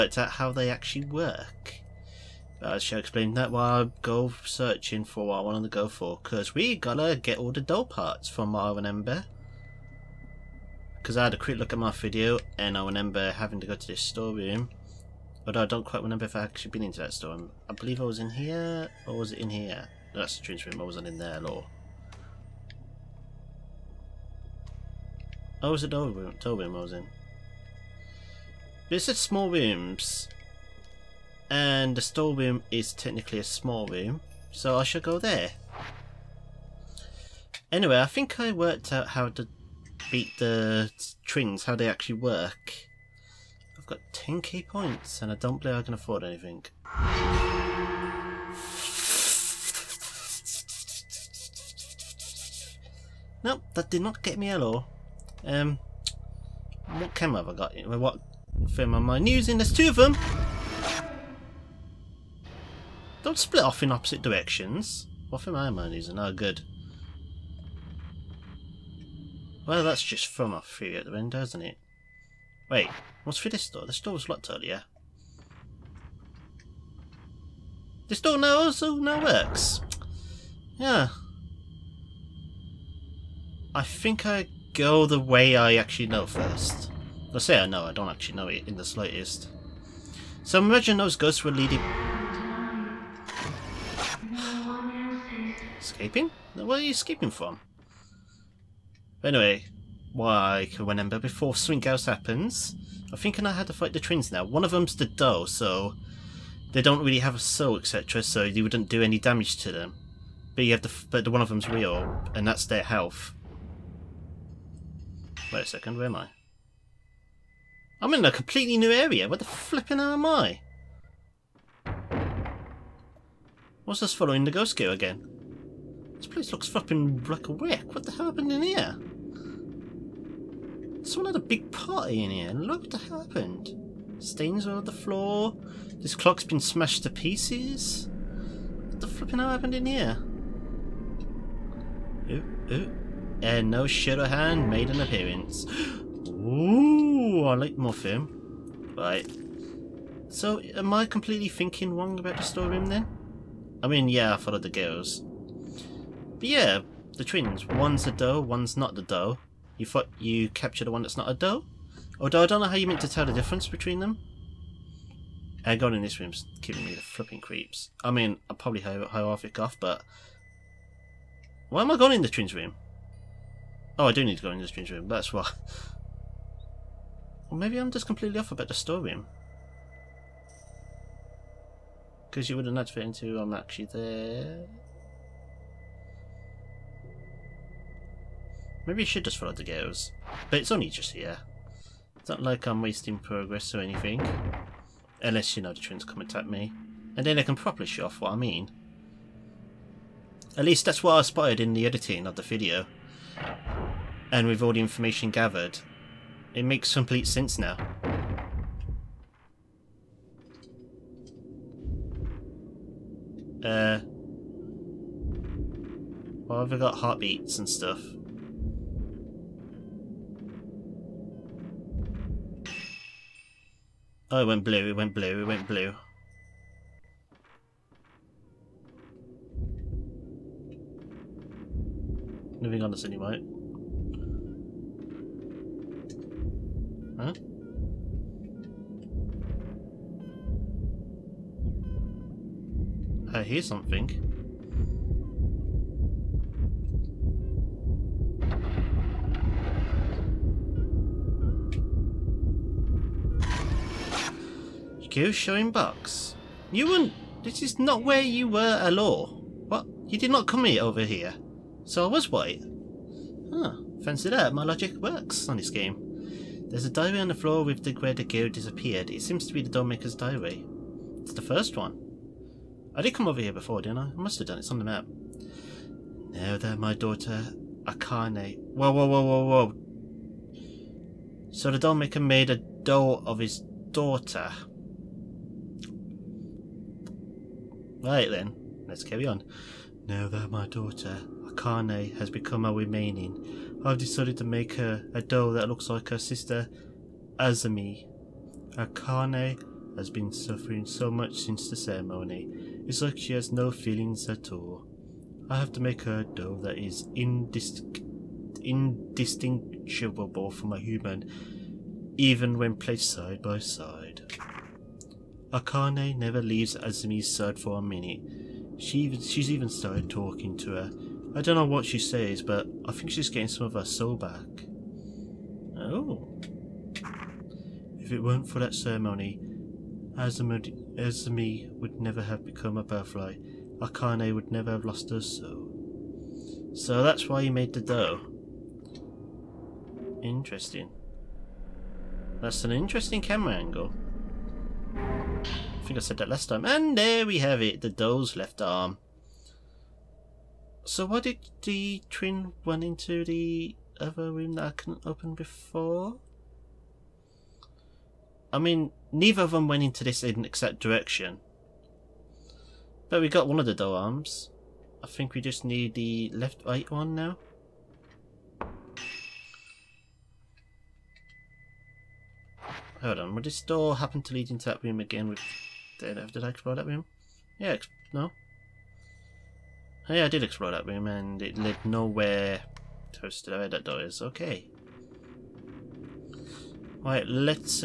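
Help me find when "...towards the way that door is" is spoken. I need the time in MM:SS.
06:23.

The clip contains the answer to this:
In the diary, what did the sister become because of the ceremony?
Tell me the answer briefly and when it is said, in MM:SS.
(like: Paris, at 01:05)
A butterfly, at 05:32.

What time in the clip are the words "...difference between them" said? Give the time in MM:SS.
02:43.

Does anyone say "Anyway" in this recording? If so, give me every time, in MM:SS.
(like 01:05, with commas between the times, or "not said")
00:37, 01:39.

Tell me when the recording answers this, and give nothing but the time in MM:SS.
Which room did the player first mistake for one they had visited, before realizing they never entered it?
00:20.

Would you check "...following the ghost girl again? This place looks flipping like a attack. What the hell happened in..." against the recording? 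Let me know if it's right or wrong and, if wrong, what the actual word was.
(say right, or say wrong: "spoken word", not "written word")
wrong: "wreck", not "attack".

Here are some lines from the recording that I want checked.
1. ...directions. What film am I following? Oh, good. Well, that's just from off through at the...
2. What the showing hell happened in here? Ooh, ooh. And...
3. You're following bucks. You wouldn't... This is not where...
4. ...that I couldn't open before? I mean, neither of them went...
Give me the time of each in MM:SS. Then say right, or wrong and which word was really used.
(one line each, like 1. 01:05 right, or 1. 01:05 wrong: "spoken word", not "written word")
1. 01:04 wrong: "using", not "following"
2. 02:18 wrong: "flipping", not "showing"
3. 04:15 wrong: "showing", not "following"
4. 05:54 right.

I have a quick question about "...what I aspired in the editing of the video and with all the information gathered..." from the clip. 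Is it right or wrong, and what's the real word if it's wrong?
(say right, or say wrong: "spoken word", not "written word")
right.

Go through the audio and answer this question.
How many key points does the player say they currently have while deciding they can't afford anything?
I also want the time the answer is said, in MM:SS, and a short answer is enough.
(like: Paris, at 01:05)
10, at 00:44.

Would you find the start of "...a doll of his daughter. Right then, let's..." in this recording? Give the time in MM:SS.
04:42.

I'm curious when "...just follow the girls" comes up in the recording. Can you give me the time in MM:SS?
03:09.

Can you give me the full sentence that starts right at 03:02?
Because you wouldn't have fit into I'm actually there.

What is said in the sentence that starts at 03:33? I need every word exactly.
Uh, why have I got heartbeats and stuff?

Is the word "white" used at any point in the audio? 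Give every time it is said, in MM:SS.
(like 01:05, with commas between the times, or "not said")
03:53, 04:22.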